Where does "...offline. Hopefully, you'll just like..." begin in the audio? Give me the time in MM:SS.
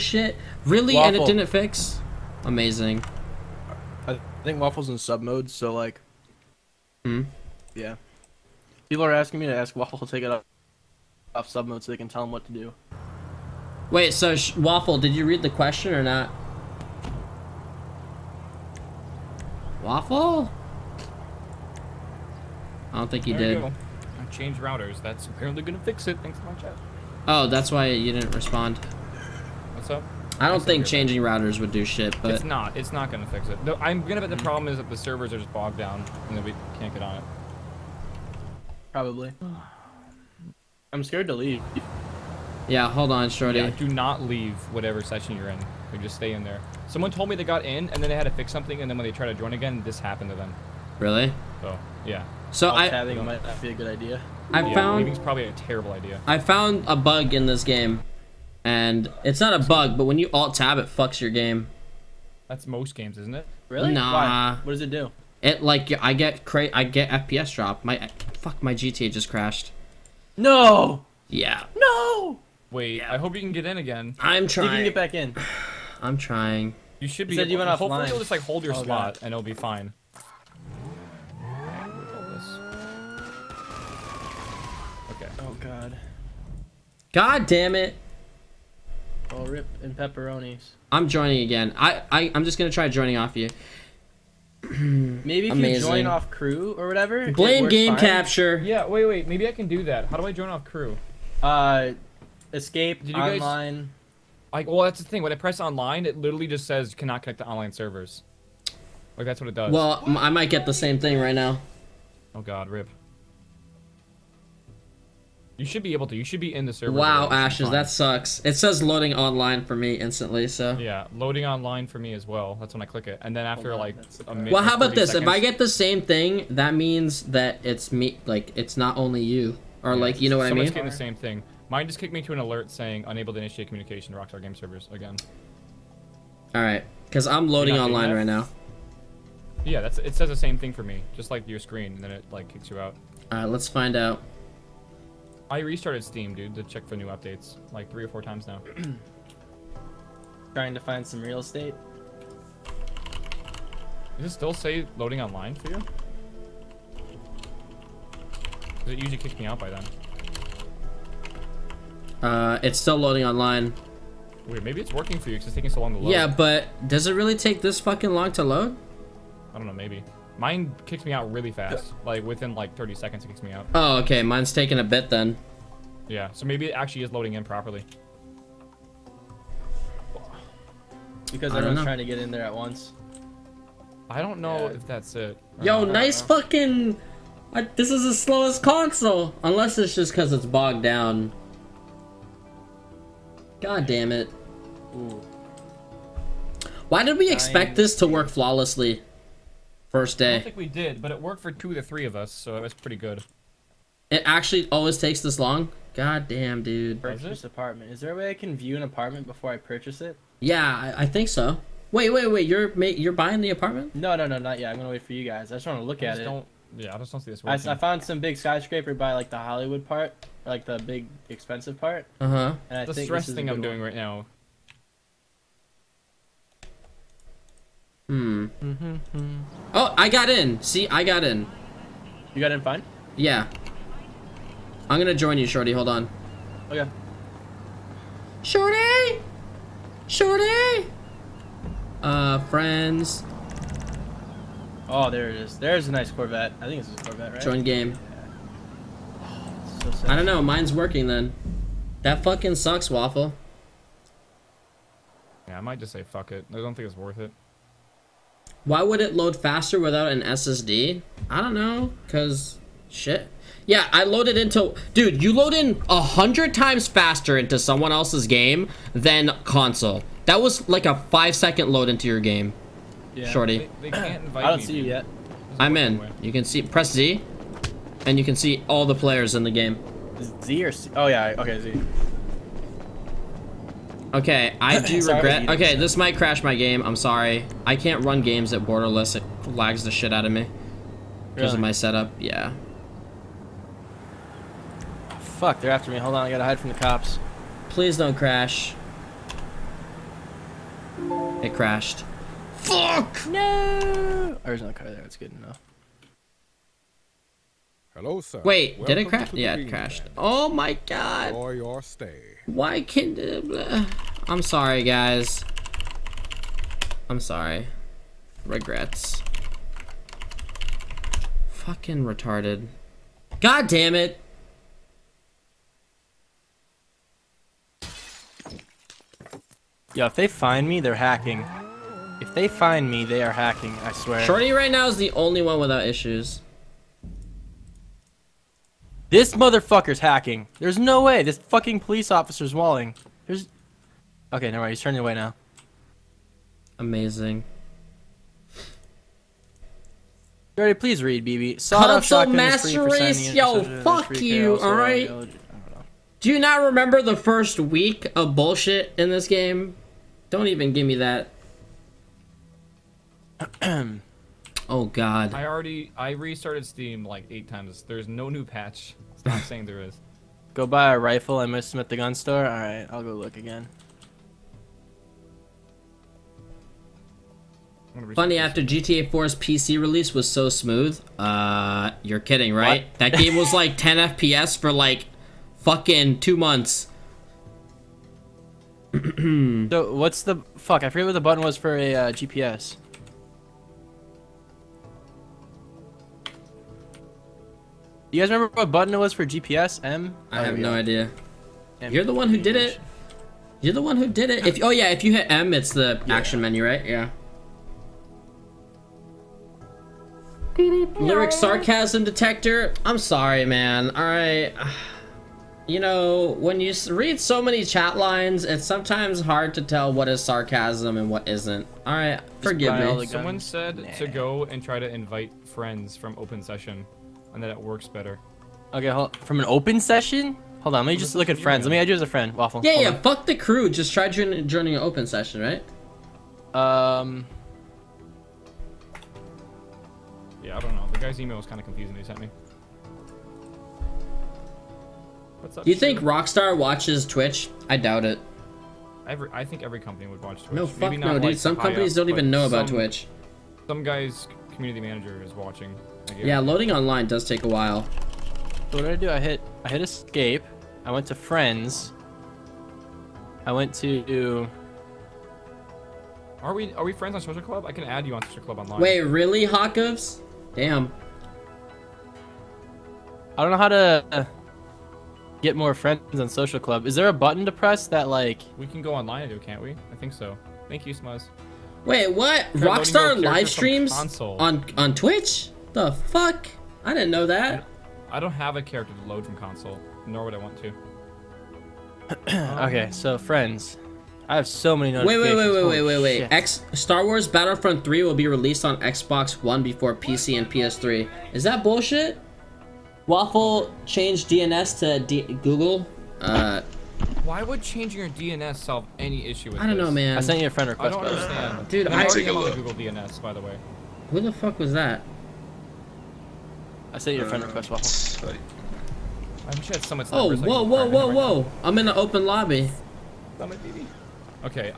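01:17.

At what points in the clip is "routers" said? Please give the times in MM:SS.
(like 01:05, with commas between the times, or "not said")
00:24, 00:31.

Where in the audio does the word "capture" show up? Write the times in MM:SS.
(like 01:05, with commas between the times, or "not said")
01:37.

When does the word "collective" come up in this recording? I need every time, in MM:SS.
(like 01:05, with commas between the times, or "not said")
not said.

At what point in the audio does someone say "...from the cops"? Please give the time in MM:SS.
04:56.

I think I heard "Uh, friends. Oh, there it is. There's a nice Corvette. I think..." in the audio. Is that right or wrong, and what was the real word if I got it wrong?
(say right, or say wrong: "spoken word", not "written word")
right.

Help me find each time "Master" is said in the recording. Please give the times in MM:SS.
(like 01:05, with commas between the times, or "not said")
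05:52.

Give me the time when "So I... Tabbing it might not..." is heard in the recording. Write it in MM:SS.
00:52.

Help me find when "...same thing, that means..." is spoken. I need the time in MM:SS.
02:05.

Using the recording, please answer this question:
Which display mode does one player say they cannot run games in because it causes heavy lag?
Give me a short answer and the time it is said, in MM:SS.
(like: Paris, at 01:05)
borderless, at 04:48.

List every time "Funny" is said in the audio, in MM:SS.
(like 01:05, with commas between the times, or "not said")
06:18.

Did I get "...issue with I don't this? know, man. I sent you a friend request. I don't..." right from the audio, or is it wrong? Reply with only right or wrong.
right.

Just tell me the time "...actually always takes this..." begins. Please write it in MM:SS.
03:24.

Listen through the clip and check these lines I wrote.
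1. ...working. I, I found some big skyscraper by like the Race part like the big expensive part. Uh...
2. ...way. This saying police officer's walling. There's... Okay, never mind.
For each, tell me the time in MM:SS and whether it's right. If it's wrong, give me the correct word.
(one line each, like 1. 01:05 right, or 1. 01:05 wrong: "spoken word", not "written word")
1. 03:37 wrong: "Hollywood", not "Race"
2. 05:41 wrong: "fucking", not "saying".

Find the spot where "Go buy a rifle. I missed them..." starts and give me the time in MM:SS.
06:10.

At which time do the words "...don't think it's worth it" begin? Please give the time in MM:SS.
04:16.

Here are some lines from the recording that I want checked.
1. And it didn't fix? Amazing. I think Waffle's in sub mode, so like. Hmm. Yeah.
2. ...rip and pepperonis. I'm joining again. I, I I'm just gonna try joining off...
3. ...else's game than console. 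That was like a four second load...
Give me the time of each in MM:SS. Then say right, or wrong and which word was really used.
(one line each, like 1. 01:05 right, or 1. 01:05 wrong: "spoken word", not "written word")
1. 00:01 right
2. 01:29 right
3. 04:27 wrong: "five", not "four".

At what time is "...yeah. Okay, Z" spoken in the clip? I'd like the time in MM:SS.
04:41.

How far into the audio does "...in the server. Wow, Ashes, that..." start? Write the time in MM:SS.
01:56.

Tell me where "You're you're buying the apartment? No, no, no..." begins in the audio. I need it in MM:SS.
03:32.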